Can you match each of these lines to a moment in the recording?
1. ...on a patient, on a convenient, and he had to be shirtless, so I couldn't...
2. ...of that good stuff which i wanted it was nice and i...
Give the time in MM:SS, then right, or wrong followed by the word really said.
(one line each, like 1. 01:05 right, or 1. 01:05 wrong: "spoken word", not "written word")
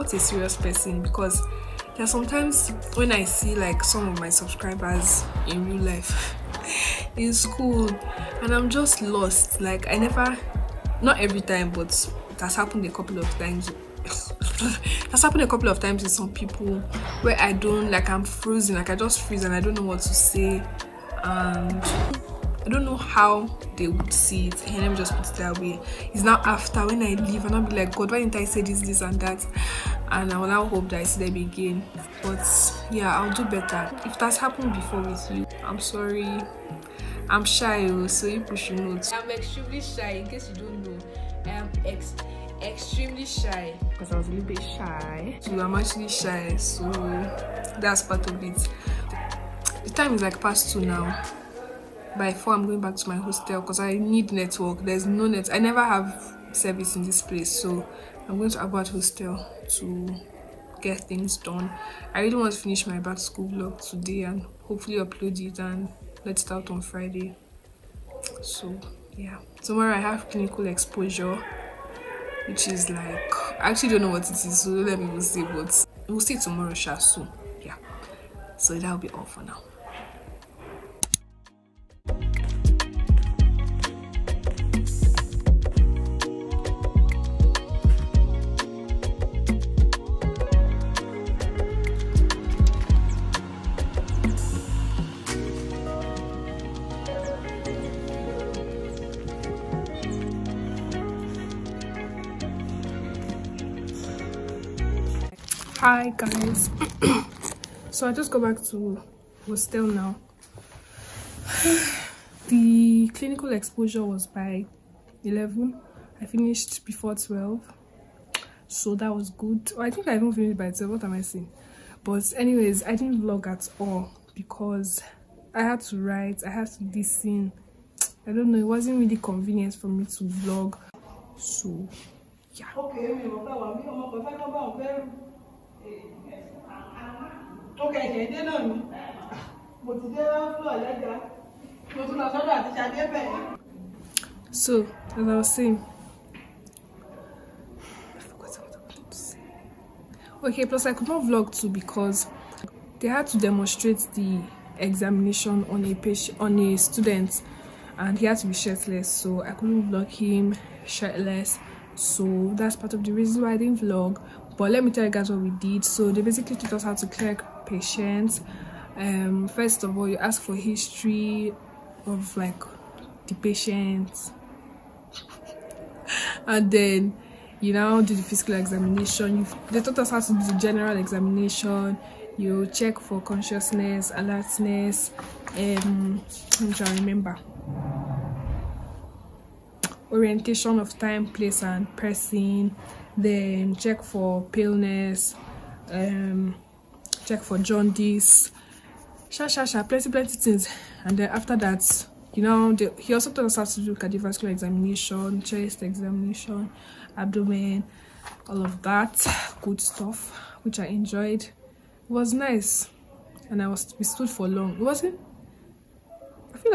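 1. 02:35 wrong: "student", not "convenient"
2. 03:28 wrong: "enjoyed", not "wanted".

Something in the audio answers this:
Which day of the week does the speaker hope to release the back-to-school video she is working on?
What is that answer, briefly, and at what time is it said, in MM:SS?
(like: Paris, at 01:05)
Friday, at 01:06.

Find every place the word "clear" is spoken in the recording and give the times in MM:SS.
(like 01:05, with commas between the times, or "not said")
02:47.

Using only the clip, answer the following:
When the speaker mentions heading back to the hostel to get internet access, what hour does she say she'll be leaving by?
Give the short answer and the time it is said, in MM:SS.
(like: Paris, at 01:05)
4, at 00:52.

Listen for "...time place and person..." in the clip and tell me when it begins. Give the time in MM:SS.
03:10.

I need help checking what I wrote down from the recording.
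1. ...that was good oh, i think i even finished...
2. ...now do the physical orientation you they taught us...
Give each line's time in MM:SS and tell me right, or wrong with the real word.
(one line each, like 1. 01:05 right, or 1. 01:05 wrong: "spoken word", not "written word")
1. 01:58 right
2. 02:57 wrong: "examination", not "orientation".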